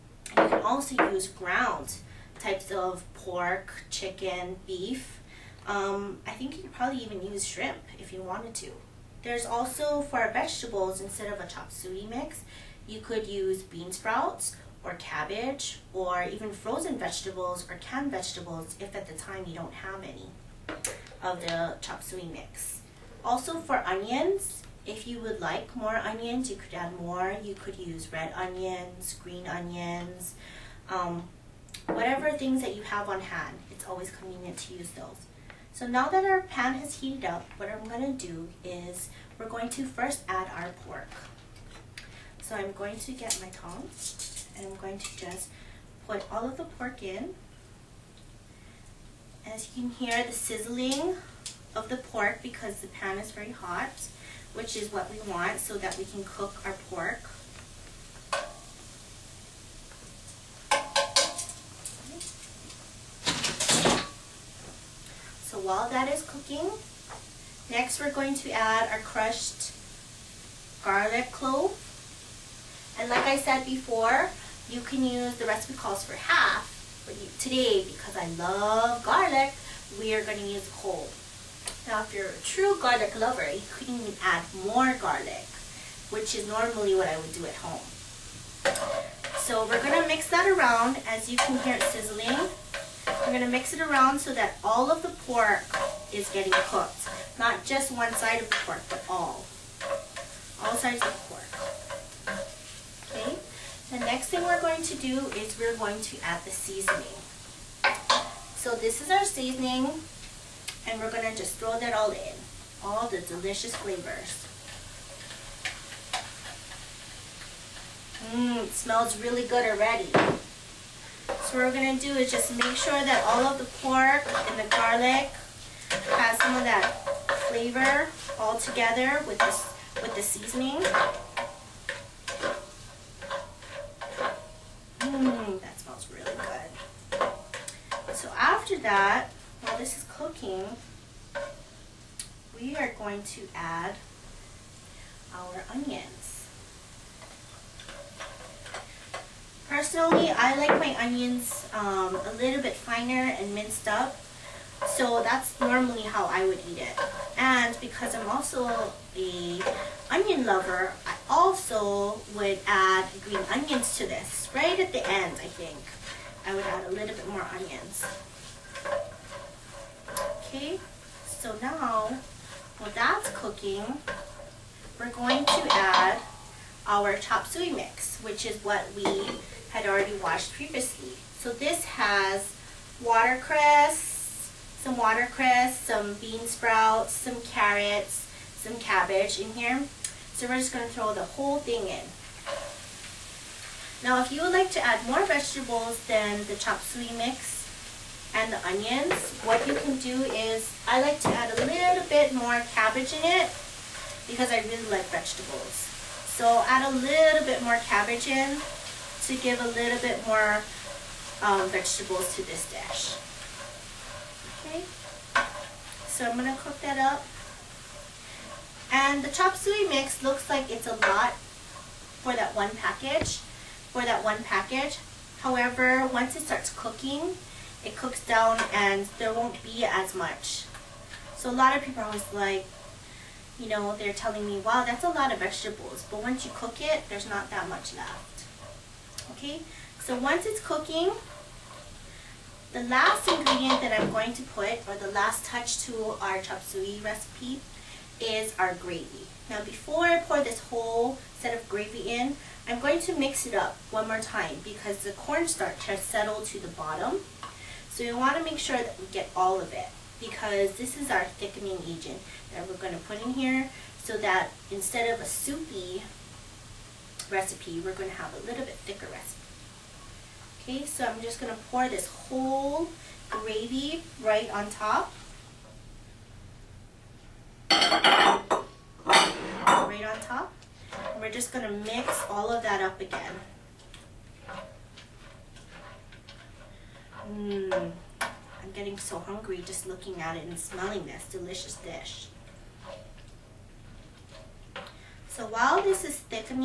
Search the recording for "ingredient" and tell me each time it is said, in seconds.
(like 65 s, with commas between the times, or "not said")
243 s.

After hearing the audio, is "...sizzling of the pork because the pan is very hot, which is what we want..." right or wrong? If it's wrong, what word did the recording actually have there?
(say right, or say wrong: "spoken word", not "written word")
right.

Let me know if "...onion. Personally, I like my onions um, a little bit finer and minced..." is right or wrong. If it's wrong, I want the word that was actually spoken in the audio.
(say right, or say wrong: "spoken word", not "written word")
right.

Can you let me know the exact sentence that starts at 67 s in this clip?
Next, we're going to add our crushed garlic clove.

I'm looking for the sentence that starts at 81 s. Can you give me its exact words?
Now, if you're a true garlic lover, you can even add more garlic, which is normally what I would do at home.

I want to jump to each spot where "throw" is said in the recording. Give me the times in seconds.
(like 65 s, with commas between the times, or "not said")
111 s, 190 s.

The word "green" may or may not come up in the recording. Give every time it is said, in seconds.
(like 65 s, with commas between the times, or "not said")
29 s, 163 s.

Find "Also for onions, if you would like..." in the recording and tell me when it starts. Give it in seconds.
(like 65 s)
23 s.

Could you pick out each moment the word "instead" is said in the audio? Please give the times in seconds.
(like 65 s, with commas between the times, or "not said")
11 s, 264 s.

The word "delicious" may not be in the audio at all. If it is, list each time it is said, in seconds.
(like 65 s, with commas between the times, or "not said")
113 s, 291 s.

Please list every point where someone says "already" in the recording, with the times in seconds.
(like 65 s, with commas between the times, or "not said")
119 s, 179 s.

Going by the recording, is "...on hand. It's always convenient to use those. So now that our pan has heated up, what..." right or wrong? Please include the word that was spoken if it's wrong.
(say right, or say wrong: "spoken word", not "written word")
right.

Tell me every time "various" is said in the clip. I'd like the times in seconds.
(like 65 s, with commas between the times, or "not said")
not said.